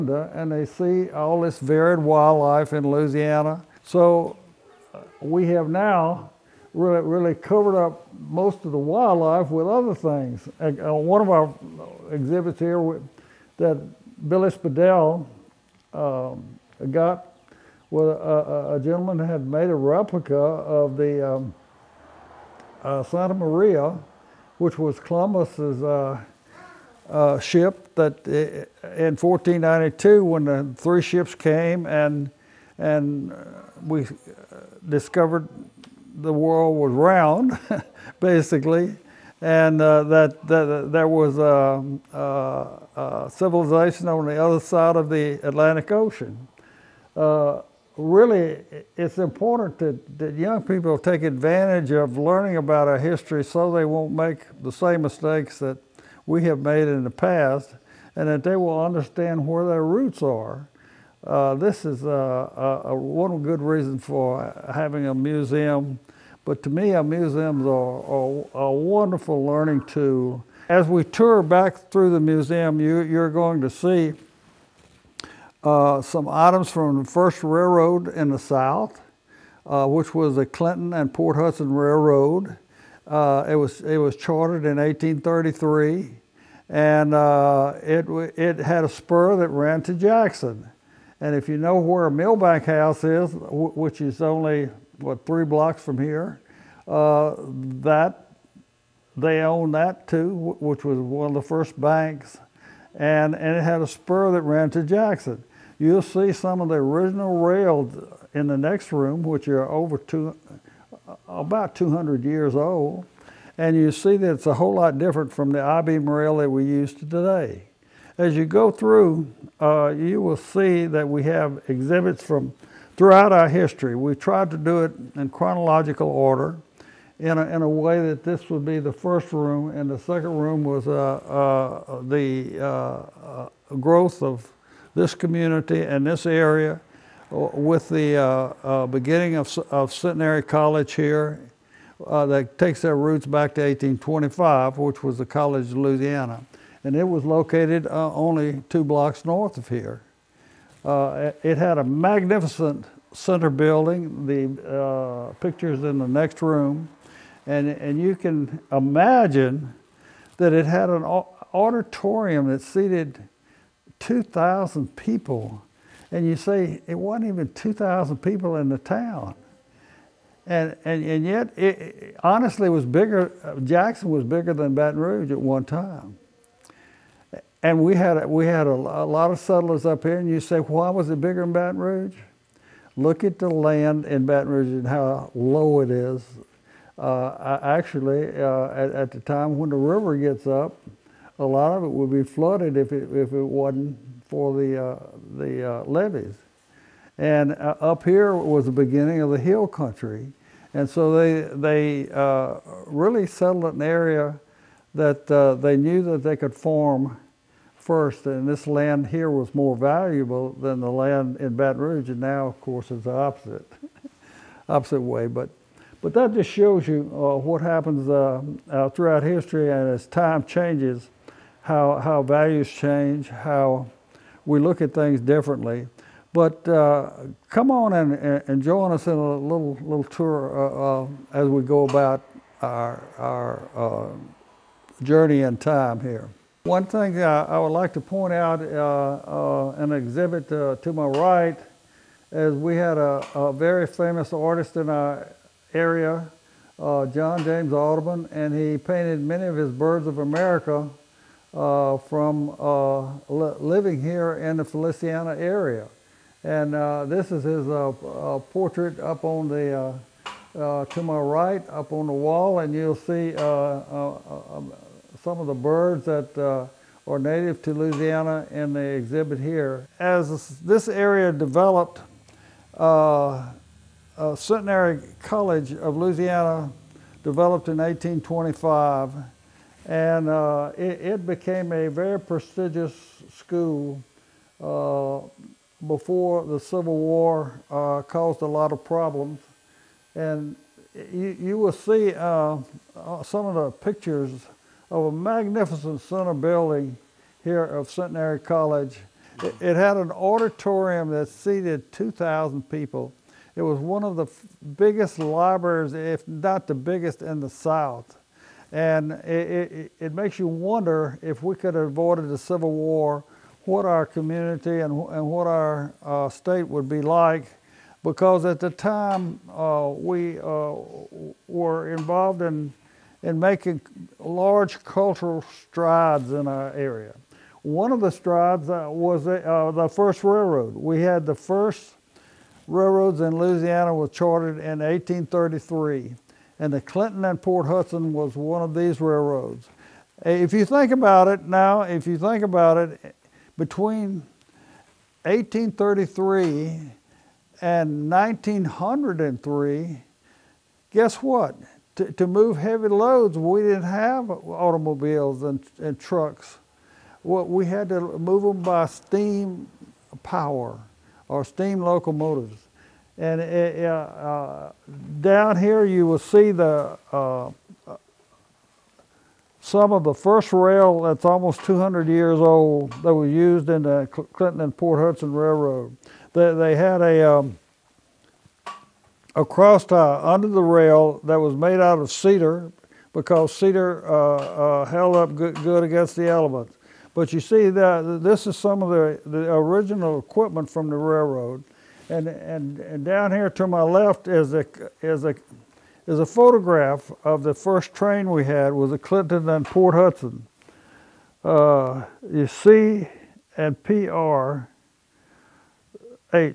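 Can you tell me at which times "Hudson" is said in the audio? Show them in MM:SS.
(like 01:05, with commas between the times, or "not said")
01:21, 05:37, 06:14, 06:39.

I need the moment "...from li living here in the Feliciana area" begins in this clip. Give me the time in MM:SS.
04:11.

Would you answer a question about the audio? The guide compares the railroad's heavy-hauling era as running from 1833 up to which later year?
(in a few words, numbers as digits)
1903.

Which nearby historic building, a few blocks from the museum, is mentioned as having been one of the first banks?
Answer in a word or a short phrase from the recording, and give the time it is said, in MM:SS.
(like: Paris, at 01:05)
Milbank House, at 01:32.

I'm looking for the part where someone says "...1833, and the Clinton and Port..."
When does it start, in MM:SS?
05:34.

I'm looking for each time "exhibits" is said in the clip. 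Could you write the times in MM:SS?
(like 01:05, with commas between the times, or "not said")
00:12, 02:01, 03:59, 04:28.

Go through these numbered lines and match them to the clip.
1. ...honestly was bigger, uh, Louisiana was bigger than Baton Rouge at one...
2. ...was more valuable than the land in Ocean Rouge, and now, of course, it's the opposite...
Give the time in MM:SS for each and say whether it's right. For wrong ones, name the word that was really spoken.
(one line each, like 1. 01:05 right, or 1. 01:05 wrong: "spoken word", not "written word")
1. 02:52 wrong: "Jackson", not "Louisiana"
2. 03:29 wrong: "Baton", not "Ocean".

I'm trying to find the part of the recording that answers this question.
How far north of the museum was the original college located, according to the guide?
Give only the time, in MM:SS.
02:28.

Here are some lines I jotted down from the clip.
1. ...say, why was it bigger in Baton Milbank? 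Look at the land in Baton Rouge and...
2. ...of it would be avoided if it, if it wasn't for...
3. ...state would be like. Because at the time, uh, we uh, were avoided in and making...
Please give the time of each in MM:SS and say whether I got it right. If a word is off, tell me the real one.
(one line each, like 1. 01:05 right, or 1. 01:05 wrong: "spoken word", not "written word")
1. 03:00 wrong: "Rouge", not "Milbank"
2. 03:11 wrong: "flooded", not "avoided"
3. 05:16 wrong: "involved", not "avoided".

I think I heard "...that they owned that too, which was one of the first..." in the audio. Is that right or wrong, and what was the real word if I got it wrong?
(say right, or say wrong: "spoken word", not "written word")
right.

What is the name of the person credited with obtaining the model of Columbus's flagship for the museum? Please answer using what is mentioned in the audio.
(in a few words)
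Billy Spadell.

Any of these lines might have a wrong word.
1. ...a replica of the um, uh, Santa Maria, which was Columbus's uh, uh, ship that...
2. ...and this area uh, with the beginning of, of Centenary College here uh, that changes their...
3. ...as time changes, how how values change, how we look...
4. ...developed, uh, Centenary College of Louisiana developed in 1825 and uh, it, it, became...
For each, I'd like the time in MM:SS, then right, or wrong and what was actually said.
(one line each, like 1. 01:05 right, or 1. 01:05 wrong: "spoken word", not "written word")
1. 00:19 right
2. 02:15 wrong: "takes", not "changes"
3. 03:39 right
4. 04:31 right.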